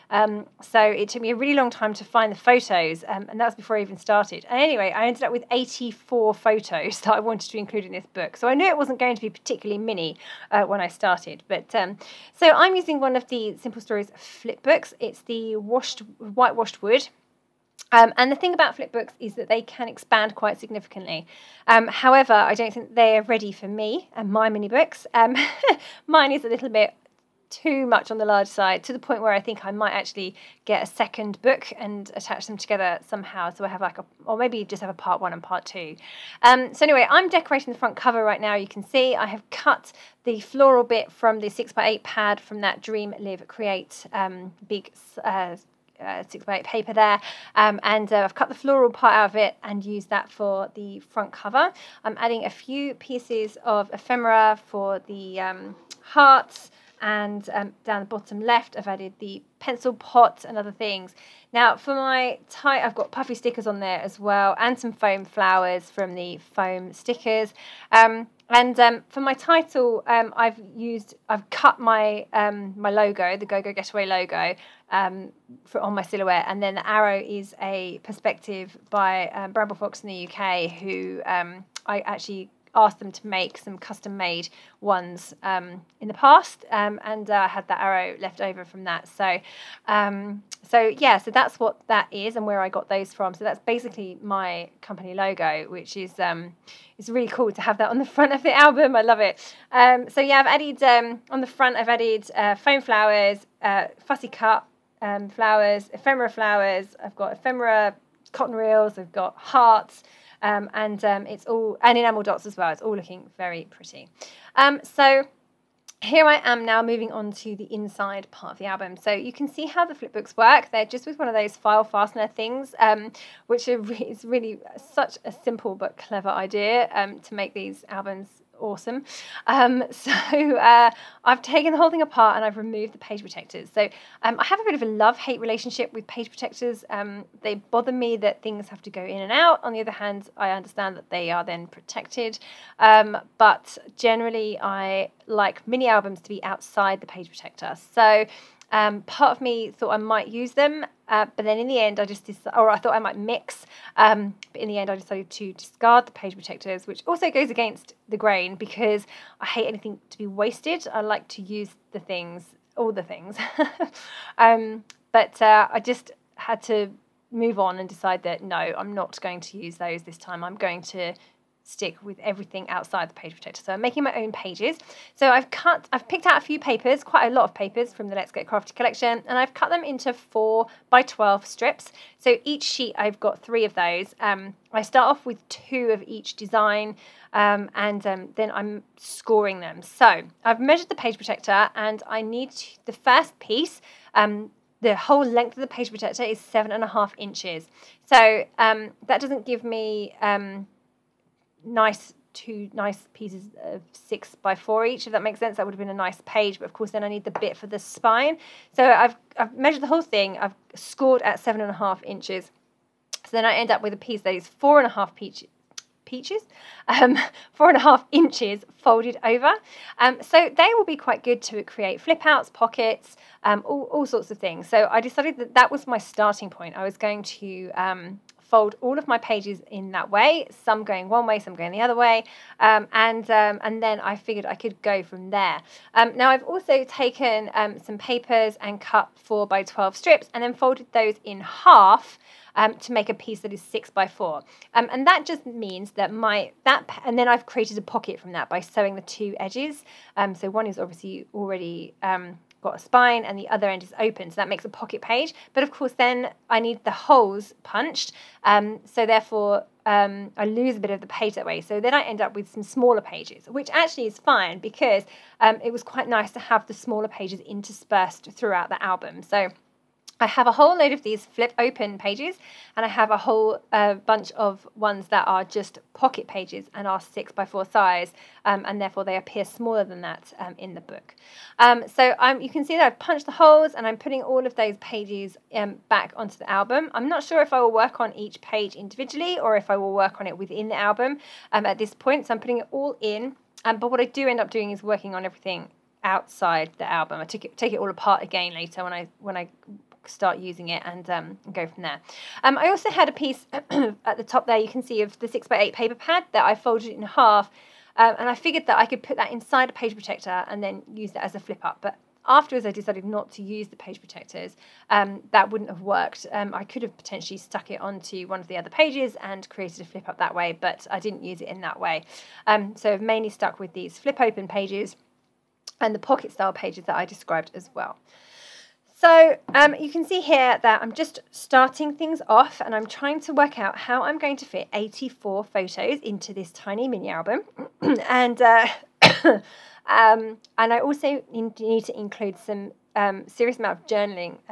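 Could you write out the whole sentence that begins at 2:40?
I like to use the things, all the things.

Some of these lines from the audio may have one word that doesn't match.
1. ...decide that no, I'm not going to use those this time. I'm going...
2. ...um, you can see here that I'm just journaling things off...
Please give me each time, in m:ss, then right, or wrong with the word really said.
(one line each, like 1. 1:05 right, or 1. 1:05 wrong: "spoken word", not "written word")
1. 2:47 right
2. 5:29 wrong: "starting", not "journaling".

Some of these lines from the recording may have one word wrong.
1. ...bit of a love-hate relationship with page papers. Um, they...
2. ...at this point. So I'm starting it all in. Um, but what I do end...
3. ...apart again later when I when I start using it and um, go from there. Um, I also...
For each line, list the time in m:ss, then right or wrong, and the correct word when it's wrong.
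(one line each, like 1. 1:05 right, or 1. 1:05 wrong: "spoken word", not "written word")
1. 2:14 wrong: "protectors", not "papers"
2. 4:51 wrong: "putting", not "starting"
3. 4:57 right.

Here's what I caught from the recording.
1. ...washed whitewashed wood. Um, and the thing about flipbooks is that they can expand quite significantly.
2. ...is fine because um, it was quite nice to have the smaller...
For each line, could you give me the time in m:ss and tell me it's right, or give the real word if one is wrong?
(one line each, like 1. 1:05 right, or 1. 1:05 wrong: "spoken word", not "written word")
1. 0:15 right
2. 4:24 right.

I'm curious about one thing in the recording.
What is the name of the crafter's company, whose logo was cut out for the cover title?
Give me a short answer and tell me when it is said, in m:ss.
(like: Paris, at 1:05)
GoGo Getaway, at 1:13.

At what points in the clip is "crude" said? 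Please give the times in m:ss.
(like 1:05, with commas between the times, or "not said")
not said.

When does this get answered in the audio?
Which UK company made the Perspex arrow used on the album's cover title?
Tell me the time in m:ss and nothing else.
1:19.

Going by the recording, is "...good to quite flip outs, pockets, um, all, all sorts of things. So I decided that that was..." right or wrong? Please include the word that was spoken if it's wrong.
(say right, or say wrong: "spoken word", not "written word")
wrong: "create", not "quite".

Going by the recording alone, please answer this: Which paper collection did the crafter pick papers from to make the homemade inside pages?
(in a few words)
Let's Get Crafty.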